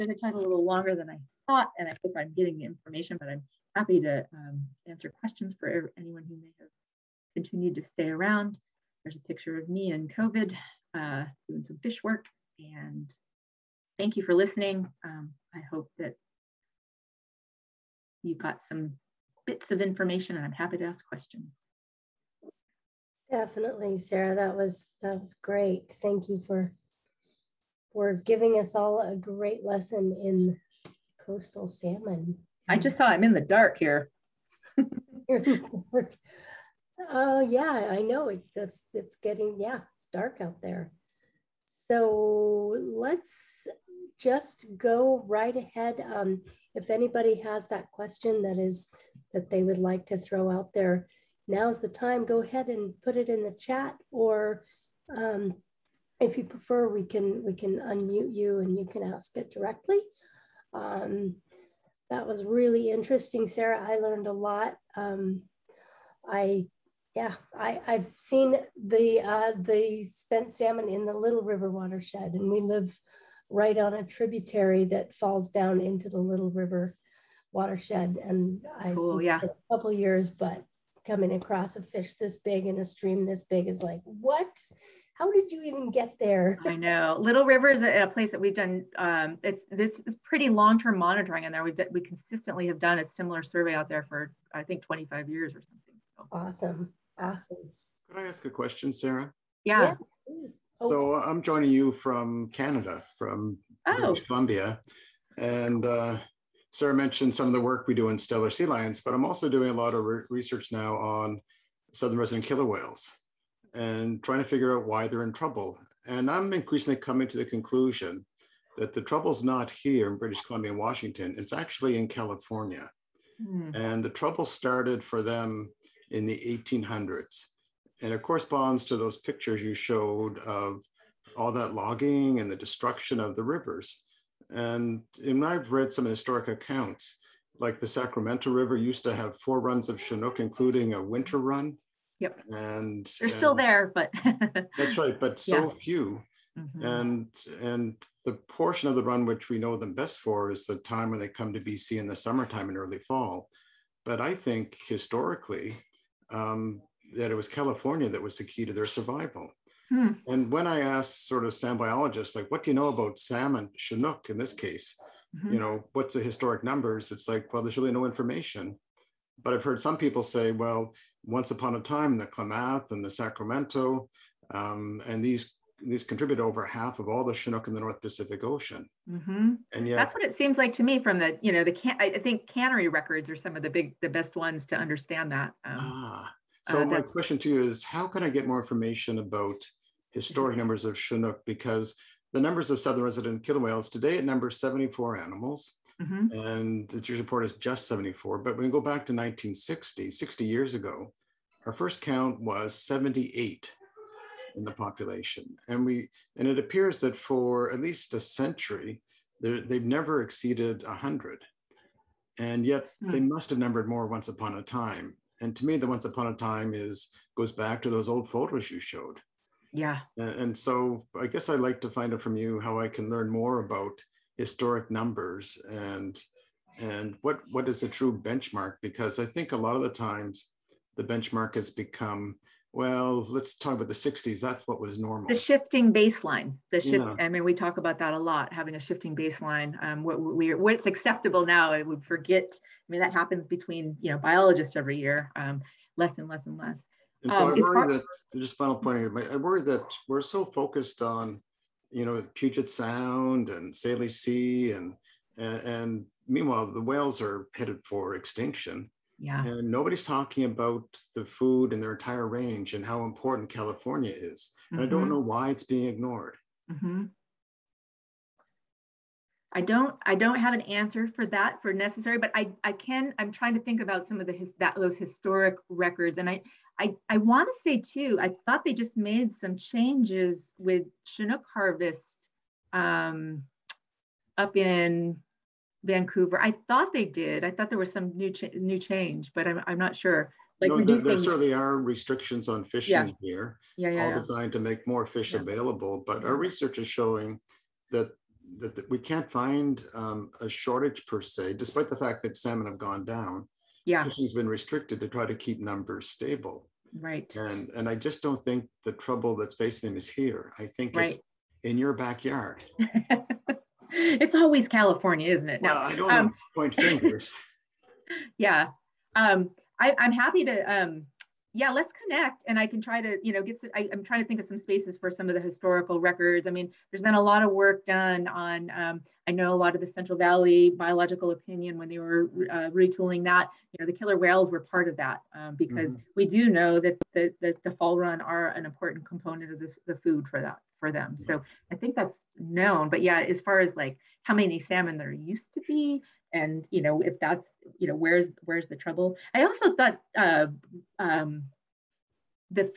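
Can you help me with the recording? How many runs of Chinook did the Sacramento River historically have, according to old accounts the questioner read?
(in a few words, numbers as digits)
4.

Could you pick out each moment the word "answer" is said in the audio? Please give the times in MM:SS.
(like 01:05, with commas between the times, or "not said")
00:04, 04:30.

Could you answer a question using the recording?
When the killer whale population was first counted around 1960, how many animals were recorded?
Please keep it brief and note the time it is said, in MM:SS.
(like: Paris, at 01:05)
78, at 03:22.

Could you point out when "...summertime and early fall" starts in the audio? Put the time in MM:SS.
02:32.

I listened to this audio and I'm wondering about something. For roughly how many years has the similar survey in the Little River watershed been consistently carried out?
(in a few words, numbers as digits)
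25 years.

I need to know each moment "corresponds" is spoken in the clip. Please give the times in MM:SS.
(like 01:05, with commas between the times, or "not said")
02:08.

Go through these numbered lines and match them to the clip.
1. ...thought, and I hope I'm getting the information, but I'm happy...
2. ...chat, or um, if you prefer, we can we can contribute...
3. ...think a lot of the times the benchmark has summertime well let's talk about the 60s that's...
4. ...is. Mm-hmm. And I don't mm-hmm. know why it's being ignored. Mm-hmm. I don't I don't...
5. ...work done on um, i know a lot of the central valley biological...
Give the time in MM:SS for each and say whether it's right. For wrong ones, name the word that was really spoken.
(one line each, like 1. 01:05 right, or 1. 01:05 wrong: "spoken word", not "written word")
1. 00:01 right
2. 00:53 wrong: "unmute", not "contribute"
3. 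03:49 wrong: "become", not "summertime"
4. 04:24 right
5. 05:27 right.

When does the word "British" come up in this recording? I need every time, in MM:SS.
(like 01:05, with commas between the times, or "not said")
01:43, 02:00.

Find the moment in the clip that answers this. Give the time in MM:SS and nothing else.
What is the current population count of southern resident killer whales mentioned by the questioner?
03:14.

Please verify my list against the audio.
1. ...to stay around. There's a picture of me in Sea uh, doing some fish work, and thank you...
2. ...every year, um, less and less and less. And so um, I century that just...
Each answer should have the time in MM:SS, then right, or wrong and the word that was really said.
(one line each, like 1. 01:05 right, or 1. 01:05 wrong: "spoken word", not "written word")
1. 00:07 wrong: "COVID", not "Sea"
2. 04:04 wrong: "worry", not "century".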